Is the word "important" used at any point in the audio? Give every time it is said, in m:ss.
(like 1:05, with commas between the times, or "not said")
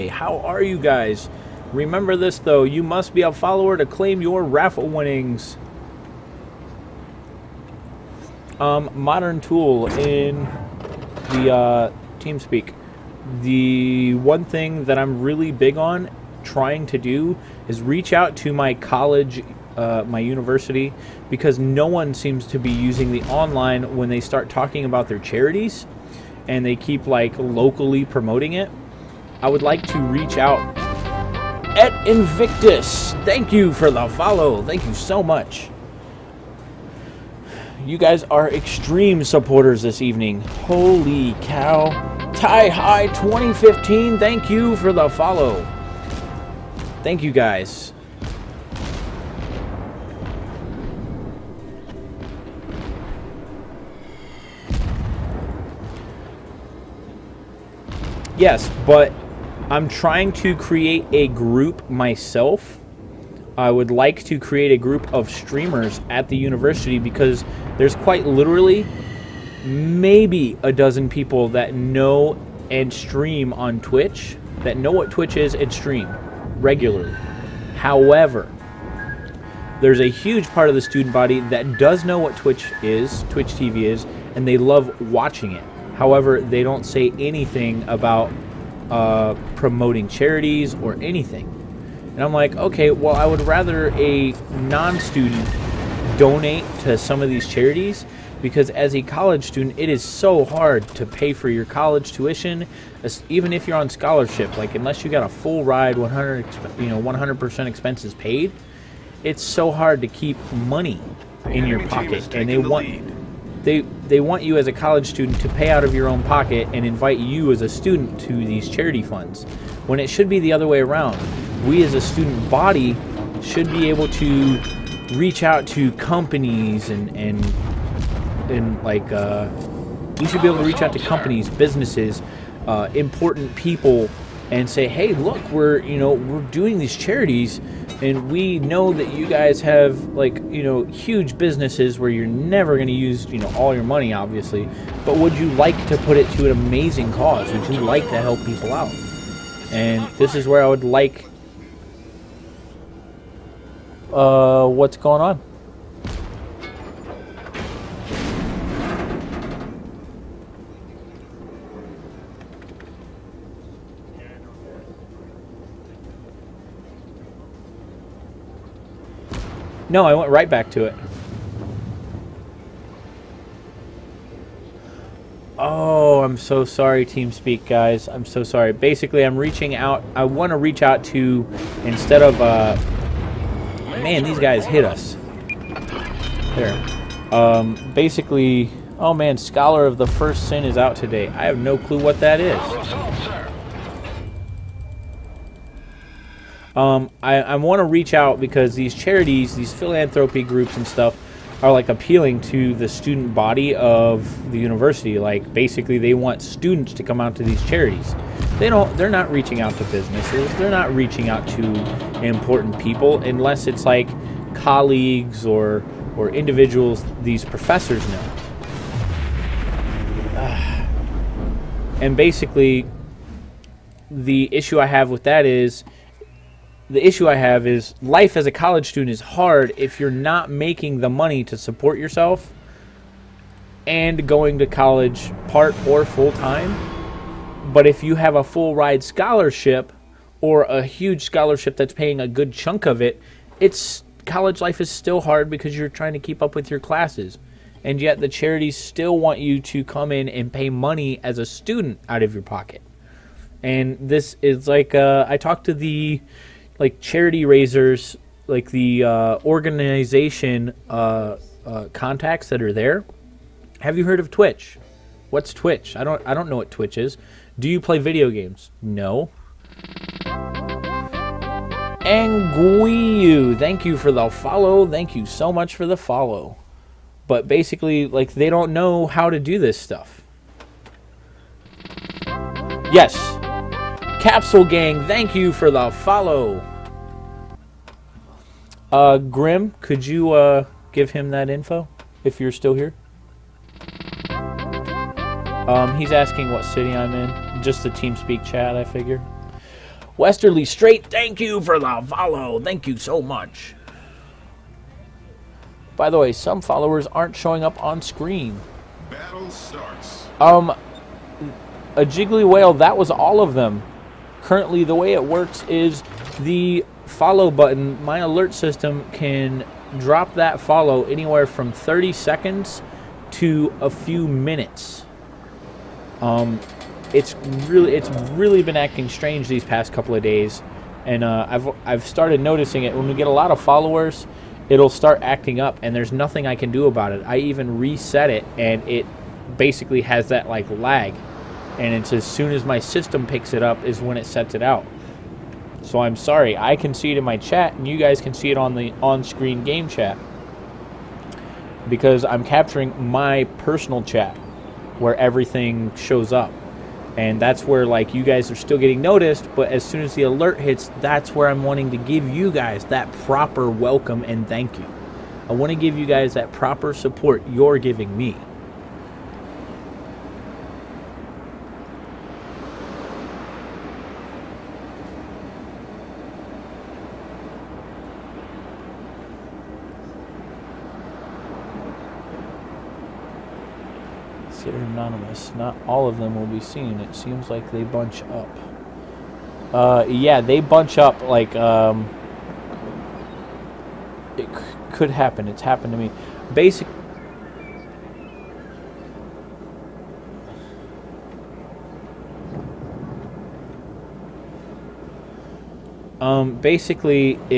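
2:12, 3:32.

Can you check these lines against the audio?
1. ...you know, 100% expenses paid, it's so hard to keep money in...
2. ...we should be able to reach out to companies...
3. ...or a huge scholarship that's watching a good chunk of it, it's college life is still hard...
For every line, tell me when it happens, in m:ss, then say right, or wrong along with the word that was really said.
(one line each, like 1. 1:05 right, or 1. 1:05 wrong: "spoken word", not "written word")
1. 1:46 right
2. 2:10 right
3. 4:00 wrong: "paying", not "watching".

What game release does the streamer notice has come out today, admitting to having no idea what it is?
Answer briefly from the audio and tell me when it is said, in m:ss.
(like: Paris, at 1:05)
Scholar of the First Sin, at 3:09.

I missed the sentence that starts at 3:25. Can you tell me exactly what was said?
Like basically, they want students to come out to these charities.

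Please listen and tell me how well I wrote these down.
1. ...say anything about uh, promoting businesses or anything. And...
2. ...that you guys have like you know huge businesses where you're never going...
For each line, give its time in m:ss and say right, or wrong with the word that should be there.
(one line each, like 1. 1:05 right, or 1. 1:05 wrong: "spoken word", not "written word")
1. 1:26 wrong: "charities", not "businesses"
2. 2:18 right.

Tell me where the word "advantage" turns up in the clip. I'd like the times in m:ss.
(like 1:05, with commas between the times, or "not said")
not said.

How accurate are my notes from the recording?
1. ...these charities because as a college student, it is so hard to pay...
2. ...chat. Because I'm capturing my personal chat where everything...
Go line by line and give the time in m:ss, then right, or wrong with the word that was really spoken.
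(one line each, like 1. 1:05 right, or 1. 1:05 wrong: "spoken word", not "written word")
1. 1:37 right
2. 5:49 right.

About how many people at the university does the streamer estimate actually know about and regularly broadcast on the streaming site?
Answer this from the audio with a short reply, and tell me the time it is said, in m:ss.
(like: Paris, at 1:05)
a dozen, at 1:09.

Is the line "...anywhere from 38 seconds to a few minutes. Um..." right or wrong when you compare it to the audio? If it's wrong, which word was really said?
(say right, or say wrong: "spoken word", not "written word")
wrong: "30", not "38".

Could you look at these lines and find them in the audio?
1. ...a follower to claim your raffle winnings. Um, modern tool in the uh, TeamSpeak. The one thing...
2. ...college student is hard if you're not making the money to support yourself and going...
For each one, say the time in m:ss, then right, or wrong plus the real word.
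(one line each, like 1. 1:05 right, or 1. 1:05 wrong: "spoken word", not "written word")
1. 0:03 right
2. 3:48 right.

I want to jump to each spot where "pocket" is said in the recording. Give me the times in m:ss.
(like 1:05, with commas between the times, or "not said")
1:51, 1:56, 4:12.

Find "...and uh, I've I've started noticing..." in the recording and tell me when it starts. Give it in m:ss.
5:31.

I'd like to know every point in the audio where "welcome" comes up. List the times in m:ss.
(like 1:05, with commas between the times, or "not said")
6:03.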